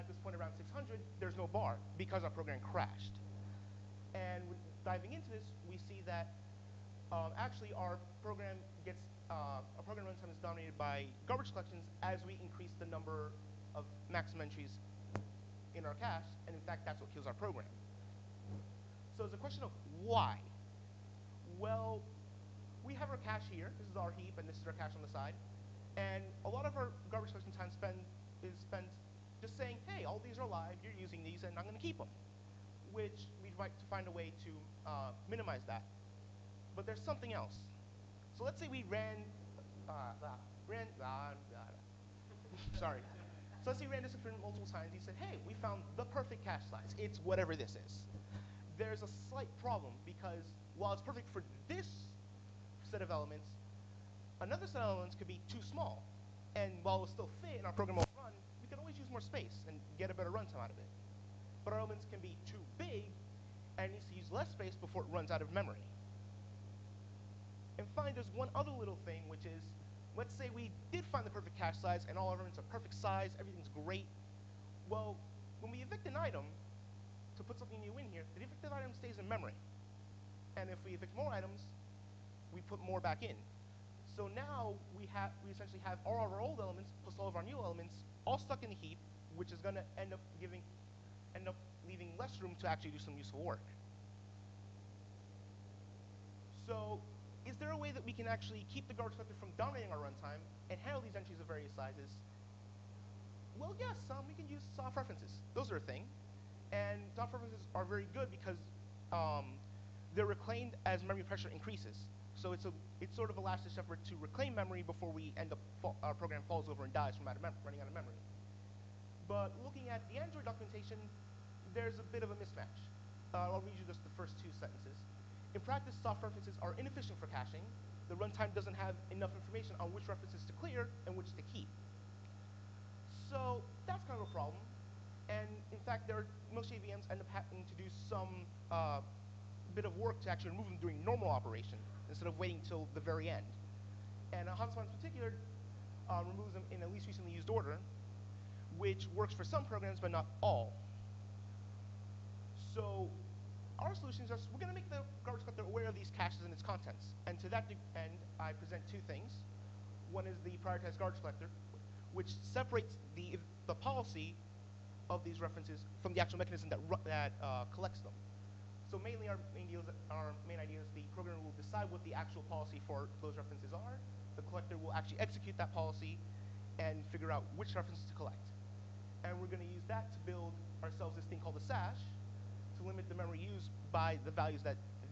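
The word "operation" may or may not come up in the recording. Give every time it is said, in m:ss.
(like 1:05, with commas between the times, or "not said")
2:21.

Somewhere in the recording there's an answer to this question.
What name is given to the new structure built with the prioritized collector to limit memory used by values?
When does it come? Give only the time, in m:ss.
3:01.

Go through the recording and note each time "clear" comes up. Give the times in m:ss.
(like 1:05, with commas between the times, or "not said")
2:10.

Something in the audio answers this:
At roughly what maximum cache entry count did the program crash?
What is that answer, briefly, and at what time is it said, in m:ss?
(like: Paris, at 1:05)
600, at 0:00.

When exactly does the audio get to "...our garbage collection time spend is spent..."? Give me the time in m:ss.
0:26.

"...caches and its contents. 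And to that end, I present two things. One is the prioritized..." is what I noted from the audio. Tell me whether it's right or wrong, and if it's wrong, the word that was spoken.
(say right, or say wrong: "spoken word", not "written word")
right.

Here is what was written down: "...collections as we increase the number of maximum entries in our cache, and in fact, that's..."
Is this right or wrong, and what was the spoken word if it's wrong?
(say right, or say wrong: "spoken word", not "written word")
right.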